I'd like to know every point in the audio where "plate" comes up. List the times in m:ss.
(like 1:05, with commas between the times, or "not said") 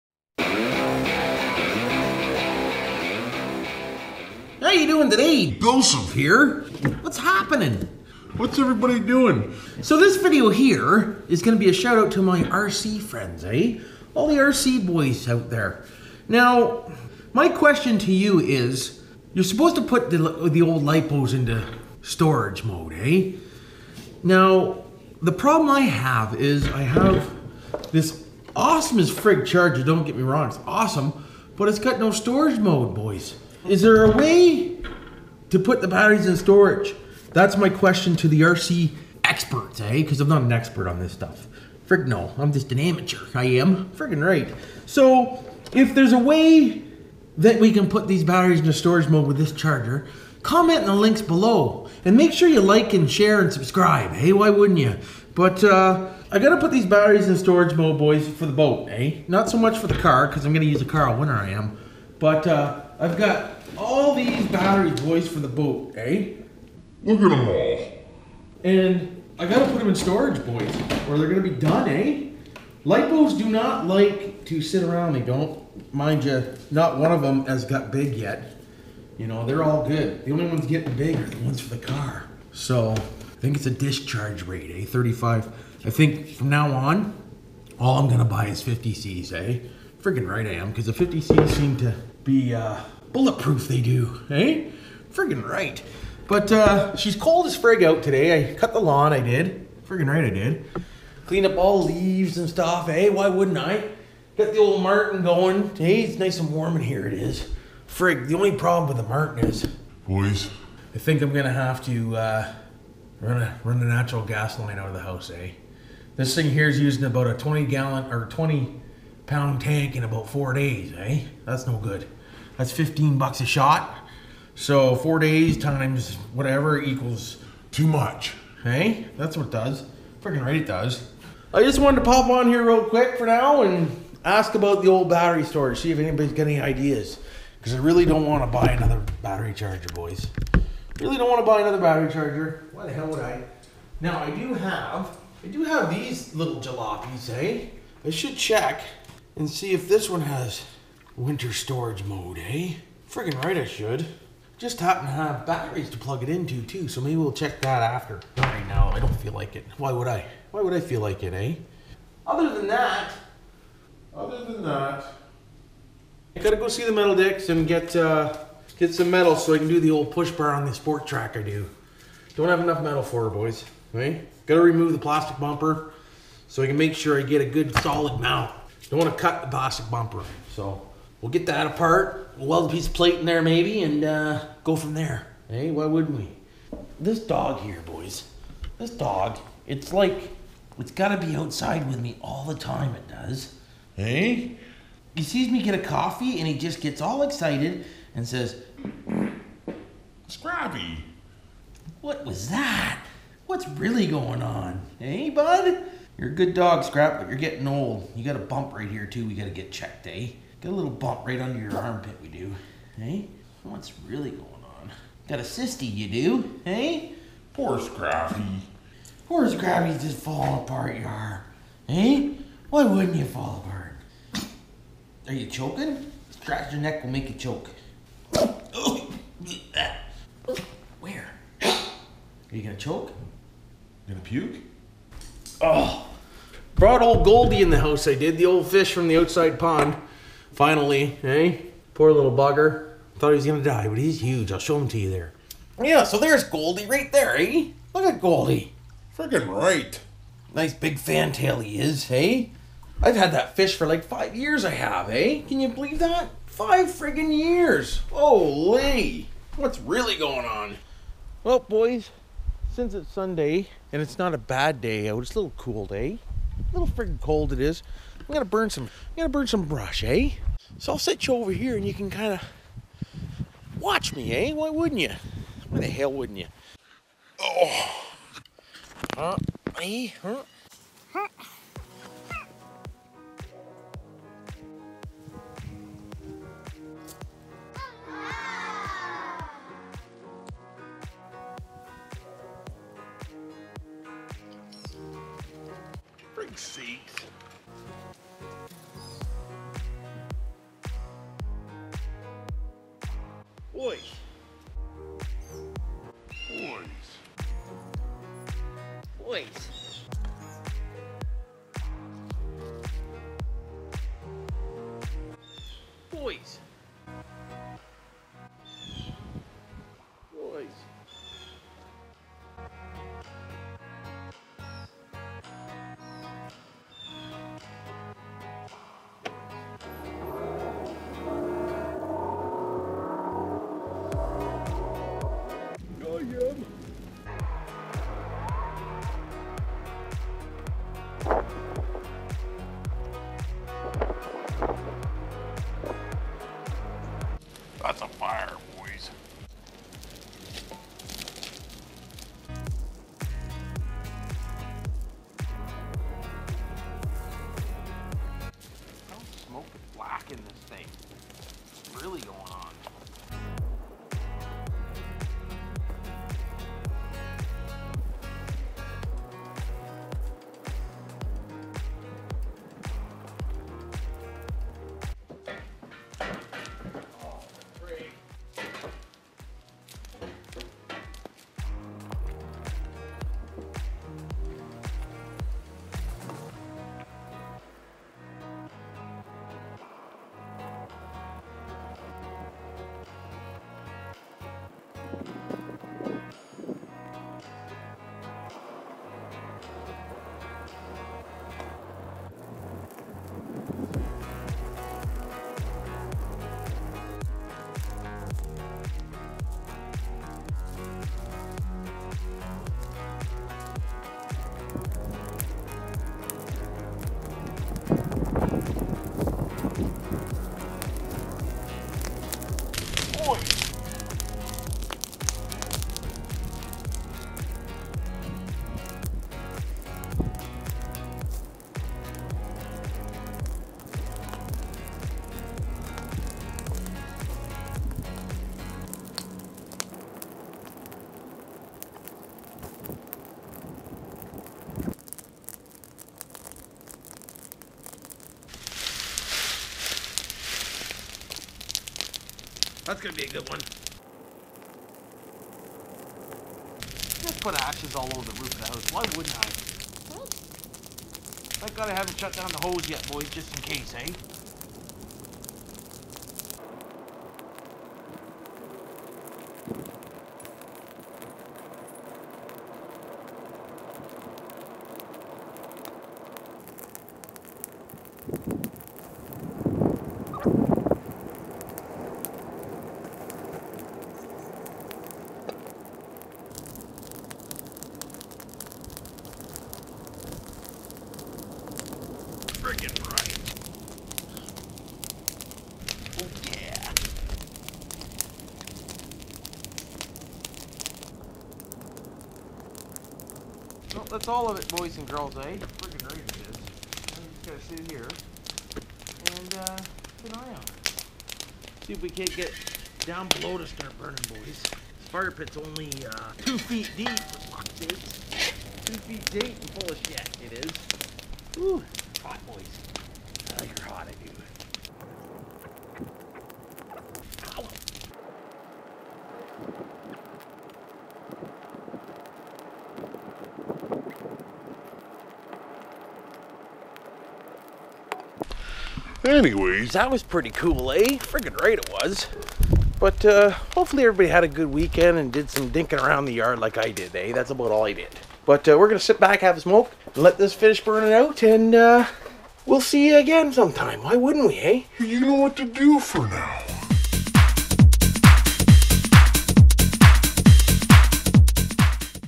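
3:02.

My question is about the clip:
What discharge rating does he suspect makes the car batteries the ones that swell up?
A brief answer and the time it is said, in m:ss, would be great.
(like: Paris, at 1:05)
35, at 1:24.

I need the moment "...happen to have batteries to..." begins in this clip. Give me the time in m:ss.
2:34.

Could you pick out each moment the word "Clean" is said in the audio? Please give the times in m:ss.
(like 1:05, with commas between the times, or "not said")
1:41.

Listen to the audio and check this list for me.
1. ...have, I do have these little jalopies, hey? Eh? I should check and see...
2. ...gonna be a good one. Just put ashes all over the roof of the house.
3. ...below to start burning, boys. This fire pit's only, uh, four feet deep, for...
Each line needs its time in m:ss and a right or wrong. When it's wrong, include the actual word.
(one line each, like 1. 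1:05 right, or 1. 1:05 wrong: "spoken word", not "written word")
1. 2:24 right
2. 7:33 right
3. 8:33 wrong: "two", not "four".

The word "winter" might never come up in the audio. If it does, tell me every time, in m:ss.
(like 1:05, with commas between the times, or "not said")
1:01, 2:31.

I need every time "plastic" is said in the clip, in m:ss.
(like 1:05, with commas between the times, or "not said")
2:54, 2:59.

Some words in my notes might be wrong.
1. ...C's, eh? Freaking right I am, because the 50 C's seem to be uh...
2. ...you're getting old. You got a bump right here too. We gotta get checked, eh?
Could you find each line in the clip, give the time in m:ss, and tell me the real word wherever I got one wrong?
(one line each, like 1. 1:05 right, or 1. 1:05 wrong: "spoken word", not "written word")
1. 1:28 right
2. 3:27 right.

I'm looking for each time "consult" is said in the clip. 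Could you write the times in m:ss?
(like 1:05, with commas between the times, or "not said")
not said.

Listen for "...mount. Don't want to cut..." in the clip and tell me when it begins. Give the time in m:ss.
2:58.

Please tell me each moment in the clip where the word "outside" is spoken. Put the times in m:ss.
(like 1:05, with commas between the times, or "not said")
3:11, 3:59.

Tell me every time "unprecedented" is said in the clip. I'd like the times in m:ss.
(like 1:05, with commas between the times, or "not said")
not said.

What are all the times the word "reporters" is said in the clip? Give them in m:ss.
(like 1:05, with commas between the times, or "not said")
not said.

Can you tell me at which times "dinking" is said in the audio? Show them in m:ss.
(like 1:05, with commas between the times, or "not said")
9:05.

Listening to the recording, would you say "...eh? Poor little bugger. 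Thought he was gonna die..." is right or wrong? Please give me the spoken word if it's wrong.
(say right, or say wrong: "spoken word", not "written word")
right.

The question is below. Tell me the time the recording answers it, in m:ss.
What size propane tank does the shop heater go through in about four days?
1:58.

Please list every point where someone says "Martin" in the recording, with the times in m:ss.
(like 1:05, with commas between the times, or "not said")
1:44, 1:49.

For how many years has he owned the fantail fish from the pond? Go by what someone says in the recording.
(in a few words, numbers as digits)
5 years.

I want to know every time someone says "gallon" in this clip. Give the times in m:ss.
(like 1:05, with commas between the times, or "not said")
1:57.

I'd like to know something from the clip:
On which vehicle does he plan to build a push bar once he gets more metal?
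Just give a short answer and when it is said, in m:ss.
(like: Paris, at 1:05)
Sport Trac, at 2:50.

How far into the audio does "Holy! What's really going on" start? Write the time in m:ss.
4:18.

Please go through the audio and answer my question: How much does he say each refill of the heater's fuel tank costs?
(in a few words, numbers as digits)
15 bucks.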